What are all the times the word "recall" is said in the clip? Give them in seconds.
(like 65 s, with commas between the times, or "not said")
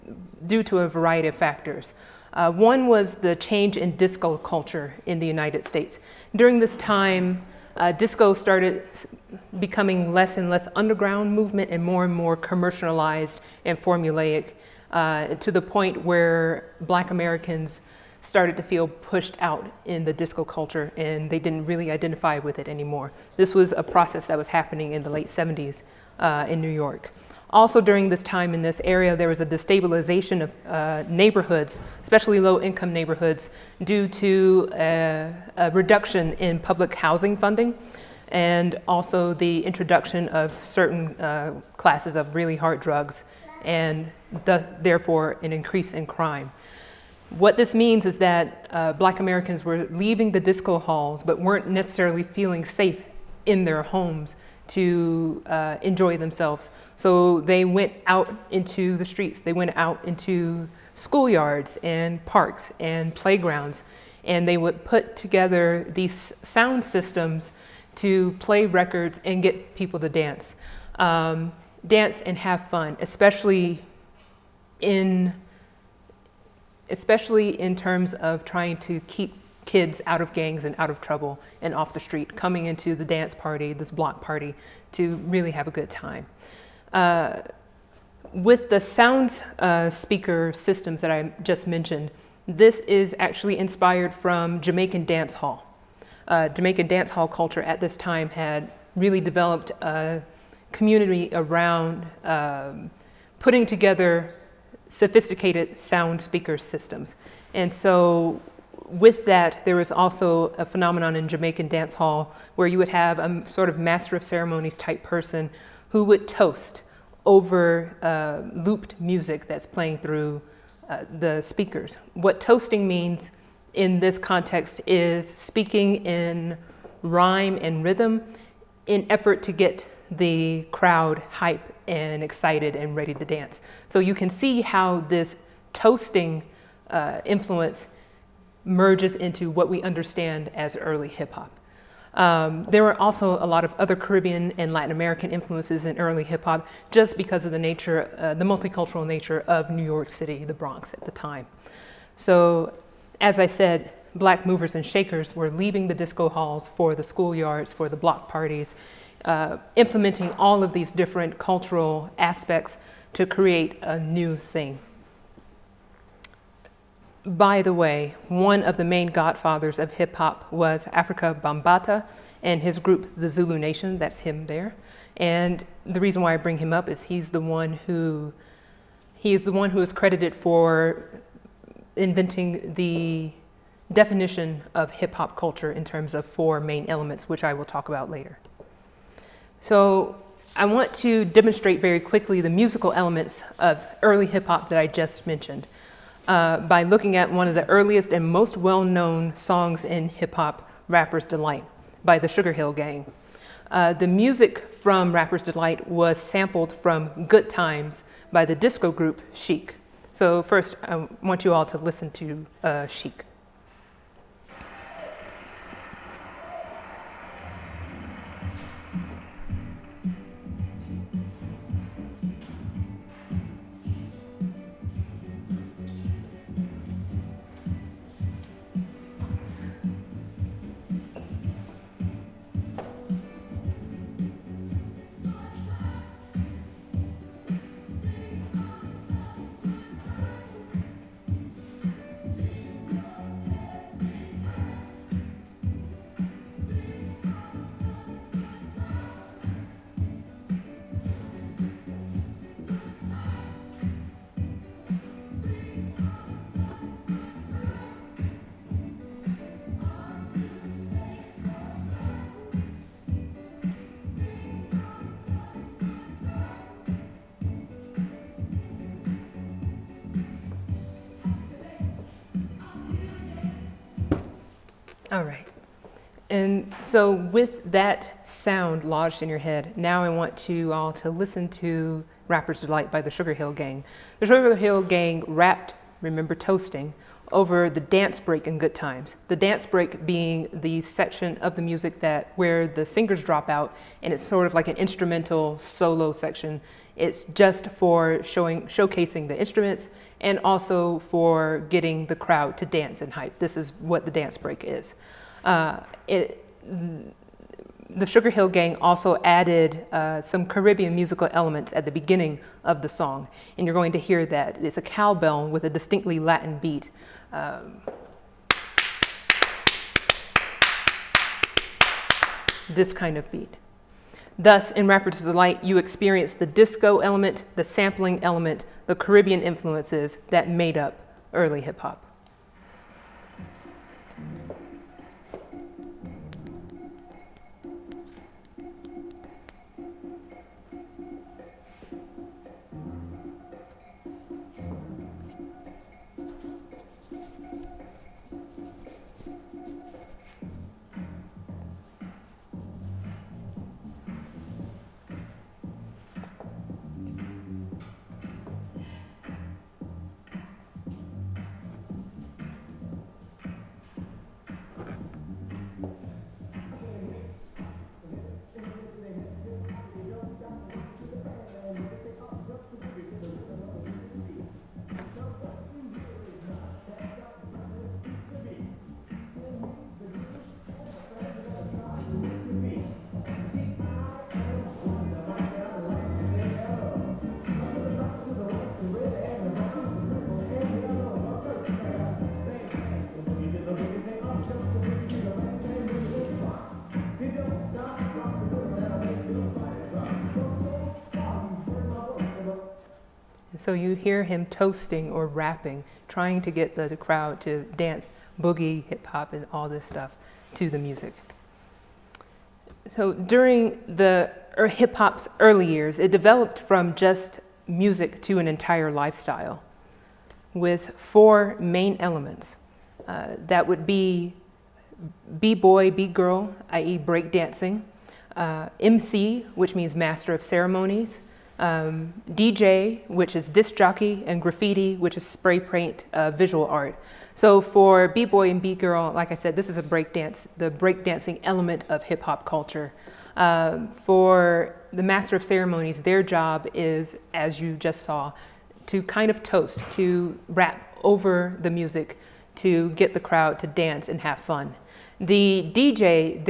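not said.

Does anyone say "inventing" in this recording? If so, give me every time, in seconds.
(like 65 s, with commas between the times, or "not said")
181 s.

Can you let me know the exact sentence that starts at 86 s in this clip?
Uh, with the sound uh, speaker systems that I just mentioned, this is actually inspired from Jamaican dance hall.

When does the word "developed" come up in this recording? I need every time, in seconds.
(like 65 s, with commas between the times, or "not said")
99 s, 416 s.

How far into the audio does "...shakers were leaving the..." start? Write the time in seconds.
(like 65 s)
154 s.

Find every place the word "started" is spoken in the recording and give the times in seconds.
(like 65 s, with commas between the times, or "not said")
8 s, 18 s.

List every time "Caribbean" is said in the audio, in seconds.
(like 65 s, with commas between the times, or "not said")
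143 s, 310 s, 328 s.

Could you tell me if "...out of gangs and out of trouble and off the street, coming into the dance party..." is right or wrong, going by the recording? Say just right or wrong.
right.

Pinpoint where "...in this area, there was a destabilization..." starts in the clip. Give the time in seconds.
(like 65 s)
28 s.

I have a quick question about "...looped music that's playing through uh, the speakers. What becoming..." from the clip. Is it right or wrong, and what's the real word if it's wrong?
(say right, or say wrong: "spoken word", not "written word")
wrong: "toasting", not "becoming".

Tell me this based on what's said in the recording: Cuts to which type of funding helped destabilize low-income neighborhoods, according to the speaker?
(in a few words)
Public housing.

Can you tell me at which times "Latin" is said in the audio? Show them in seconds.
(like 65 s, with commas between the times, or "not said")
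144 s, 316 s.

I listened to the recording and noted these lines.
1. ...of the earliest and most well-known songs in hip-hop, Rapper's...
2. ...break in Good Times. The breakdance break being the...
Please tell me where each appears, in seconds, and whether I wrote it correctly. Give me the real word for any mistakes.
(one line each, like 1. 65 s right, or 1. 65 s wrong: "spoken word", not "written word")
1. 197 s right
2. 288 s wrong: "dance", not "breakdance".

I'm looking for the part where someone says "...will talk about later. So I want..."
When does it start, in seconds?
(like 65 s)
187 s.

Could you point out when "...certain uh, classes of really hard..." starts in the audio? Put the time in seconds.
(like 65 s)
40 s.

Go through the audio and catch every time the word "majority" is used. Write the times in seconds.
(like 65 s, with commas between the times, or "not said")
not said.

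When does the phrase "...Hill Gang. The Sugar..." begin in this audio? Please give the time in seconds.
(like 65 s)
283 s.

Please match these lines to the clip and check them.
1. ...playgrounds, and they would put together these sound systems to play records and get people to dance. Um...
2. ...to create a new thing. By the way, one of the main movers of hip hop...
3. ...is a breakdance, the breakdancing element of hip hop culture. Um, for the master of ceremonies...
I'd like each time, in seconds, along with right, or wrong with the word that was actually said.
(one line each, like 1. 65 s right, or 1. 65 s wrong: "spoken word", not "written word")
1. 63 s right
2. 163 s wrong: "godfathers", not "movers"
3. 439 s right.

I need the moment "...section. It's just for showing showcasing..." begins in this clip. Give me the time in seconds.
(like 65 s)
296 s.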